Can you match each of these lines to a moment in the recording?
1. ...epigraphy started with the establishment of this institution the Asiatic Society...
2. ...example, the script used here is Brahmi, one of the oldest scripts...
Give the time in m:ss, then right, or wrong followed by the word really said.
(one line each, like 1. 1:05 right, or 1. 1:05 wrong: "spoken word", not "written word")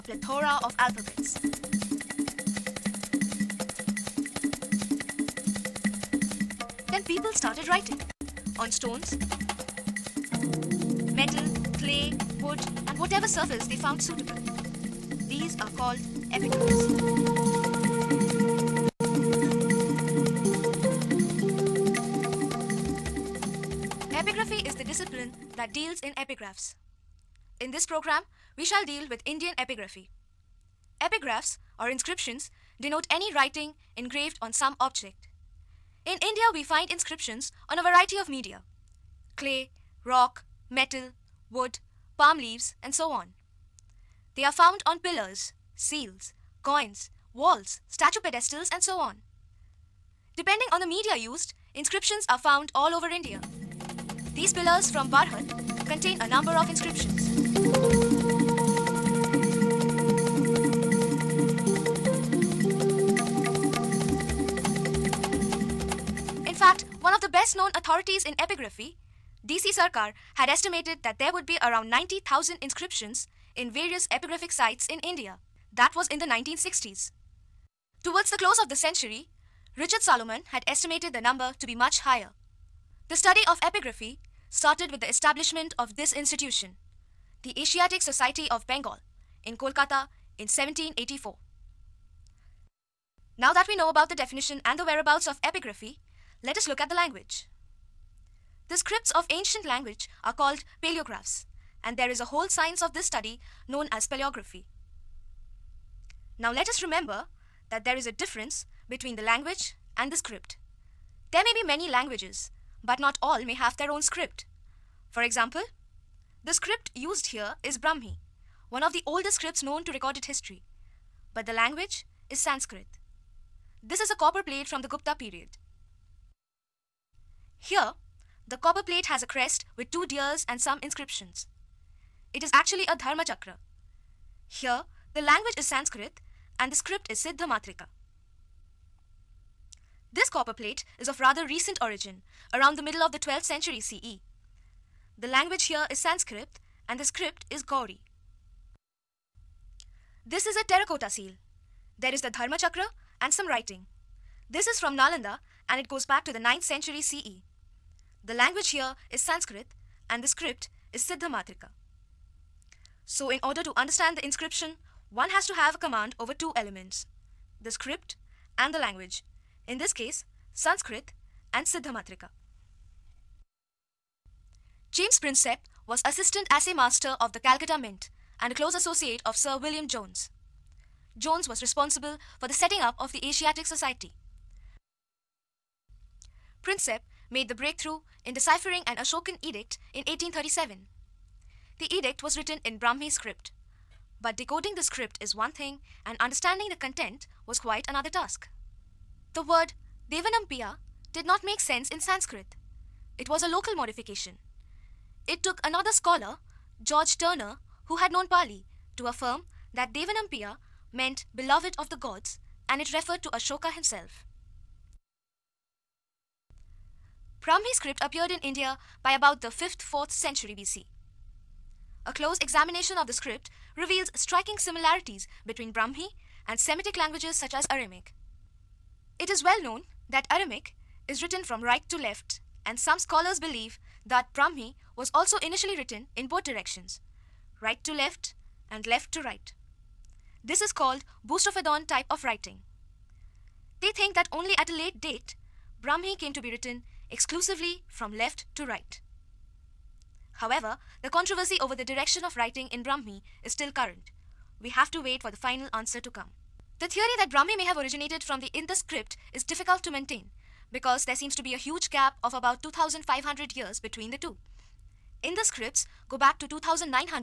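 1. 1:23 right
2. 1:55 right.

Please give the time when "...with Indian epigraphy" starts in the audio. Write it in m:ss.
0:29.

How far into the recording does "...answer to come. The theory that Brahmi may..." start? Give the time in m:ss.
4:15.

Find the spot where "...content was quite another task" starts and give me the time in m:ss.
3:16.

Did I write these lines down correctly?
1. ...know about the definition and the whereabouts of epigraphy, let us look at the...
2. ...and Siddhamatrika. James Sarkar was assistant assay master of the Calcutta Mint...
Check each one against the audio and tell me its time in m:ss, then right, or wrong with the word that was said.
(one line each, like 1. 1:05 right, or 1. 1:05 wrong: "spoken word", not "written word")
1. 1:33 right
2. 2:51 wrong: "Prinsep", not "Sarkar".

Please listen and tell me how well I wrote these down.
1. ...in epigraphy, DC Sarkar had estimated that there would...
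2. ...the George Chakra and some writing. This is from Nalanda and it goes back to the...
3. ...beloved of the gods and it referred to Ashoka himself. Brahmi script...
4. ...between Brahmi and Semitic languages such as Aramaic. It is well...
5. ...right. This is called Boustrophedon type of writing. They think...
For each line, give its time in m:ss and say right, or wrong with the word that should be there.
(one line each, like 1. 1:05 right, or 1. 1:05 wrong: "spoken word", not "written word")
1. 1:08 right
2. 2:32 wrong: "Dharma", not "George"
3. 3:31 right
4. 3:45 right
5. 3:59 right.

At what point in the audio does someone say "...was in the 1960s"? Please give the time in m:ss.
1:15.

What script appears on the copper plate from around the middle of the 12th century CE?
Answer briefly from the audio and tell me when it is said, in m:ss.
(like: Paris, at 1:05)
Gaudi, at 2:27.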